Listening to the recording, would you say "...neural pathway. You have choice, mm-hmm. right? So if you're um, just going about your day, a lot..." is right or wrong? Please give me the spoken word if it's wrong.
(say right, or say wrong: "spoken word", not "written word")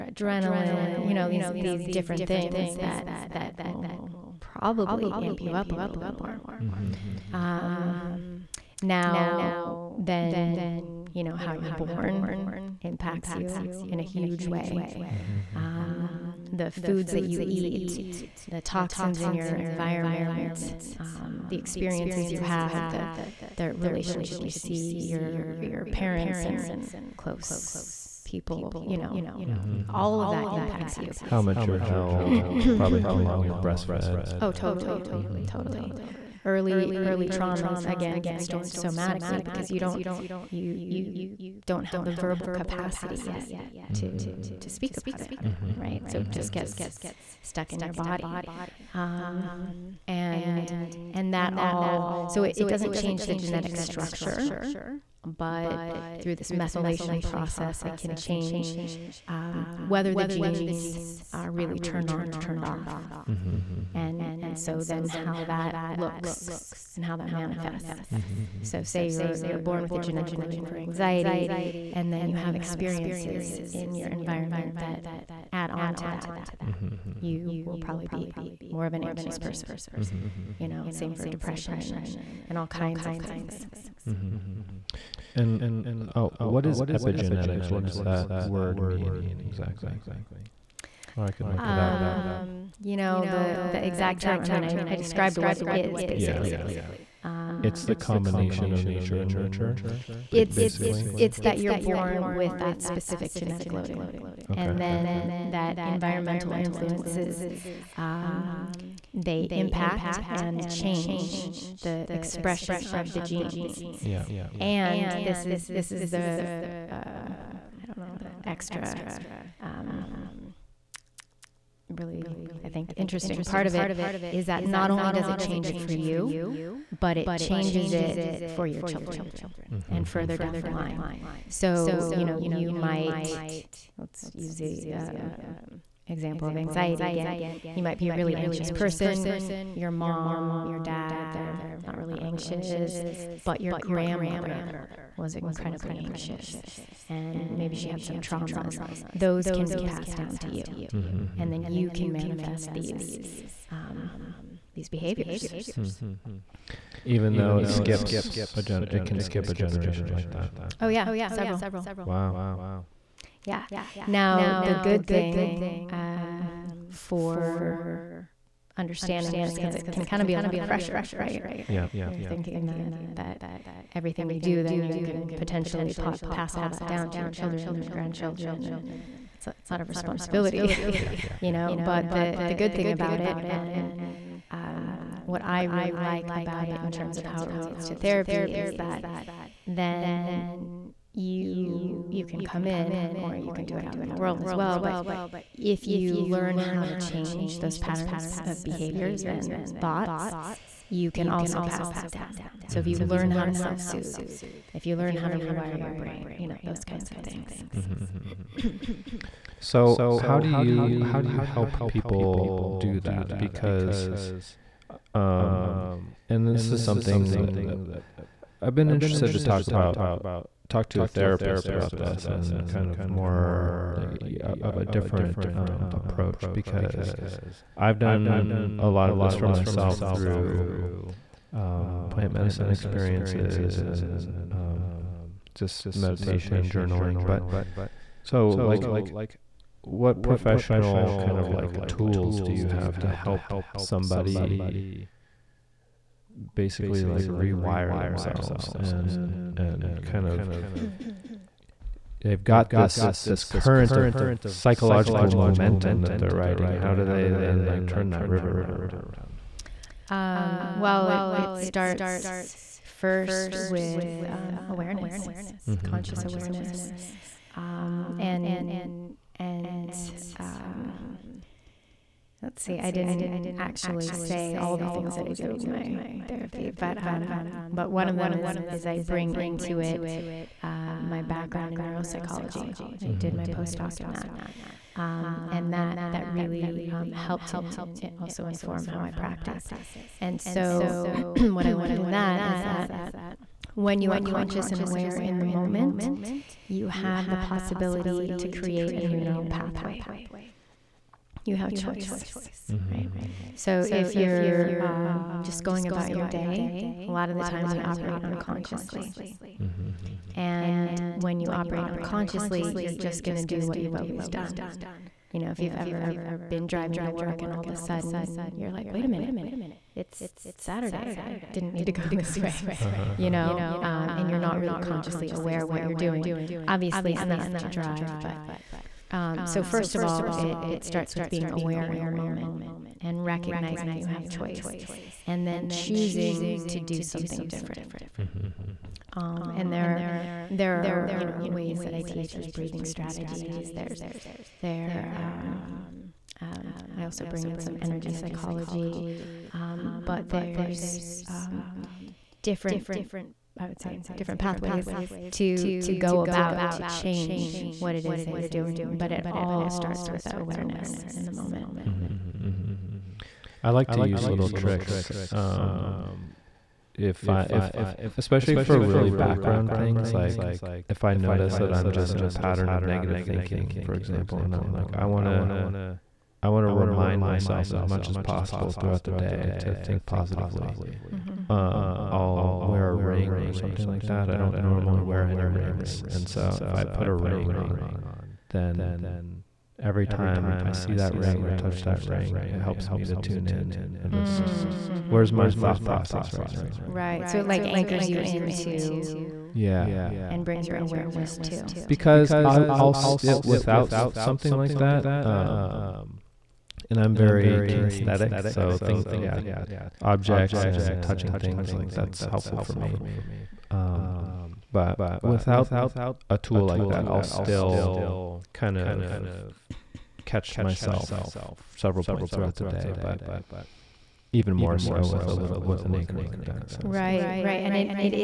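right.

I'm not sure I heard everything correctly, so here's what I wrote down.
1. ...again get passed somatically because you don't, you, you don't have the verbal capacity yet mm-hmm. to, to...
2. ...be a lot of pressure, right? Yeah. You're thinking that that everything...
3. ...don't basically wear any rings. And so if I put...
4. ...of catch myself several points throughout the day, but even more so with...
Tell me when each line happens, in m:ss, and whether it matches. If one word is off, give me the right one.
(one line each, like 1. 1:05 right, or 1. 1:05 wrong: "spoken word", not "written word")
1. 0:37 wrong: "stored", not "passed"
2. 2:50 right
3. 6:24 wrong: "normally", not "basically"
4. 6:58 right.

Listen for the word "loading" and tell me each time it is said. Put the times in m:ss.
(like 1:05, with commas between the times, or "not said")
1:10, 1:43.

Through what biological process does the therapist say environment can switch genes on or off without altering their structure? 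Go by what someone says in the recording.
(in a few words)
methylation.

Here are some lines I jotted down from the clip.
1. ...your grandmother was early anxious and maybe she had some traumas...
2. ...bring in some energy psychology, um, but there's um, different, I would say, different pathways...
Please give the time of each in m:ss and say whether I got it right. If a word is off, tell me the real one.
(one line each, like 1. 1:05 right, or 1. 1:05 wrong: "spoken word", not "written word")
1. 2:23 wrong: "incredibly", not "early"
2. 5:47 right.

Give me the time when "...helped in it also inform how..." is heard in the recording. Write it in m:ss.
4:47.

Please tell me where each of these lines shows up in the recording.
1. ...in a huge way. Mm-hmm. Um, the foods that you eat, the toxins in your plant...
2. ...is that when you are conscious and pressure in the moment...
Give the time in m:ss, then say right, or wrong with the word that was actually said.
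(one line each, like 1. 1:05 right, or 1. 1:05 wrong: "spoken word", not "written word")
1. 0:13 wrong: "environment", not "plant"
2. 4:52 wrong: "aware", not "pressure".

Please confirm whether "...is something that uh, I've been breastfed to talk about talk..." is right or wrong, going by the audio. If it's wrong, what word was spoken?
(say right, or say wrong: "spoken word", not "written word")
wrong: "interested", not "breastfed".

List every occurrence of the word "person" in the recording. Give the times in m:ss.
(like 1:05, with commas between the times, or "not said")
1:19, 2:18.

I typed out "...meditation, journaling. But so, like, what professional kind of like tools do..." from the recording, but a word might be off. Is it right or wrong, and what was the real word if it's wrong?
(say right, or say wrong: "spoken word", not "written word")
right.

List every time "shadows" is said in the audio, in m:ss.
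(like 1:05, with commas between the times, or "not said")
not said.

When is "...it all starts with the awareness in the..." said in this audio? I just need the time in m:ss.
5:59.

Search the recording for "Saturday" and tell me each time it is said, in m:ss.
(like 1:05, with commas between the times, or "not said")
5:20.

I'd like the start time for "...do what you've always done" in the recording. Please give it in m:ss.
5:13.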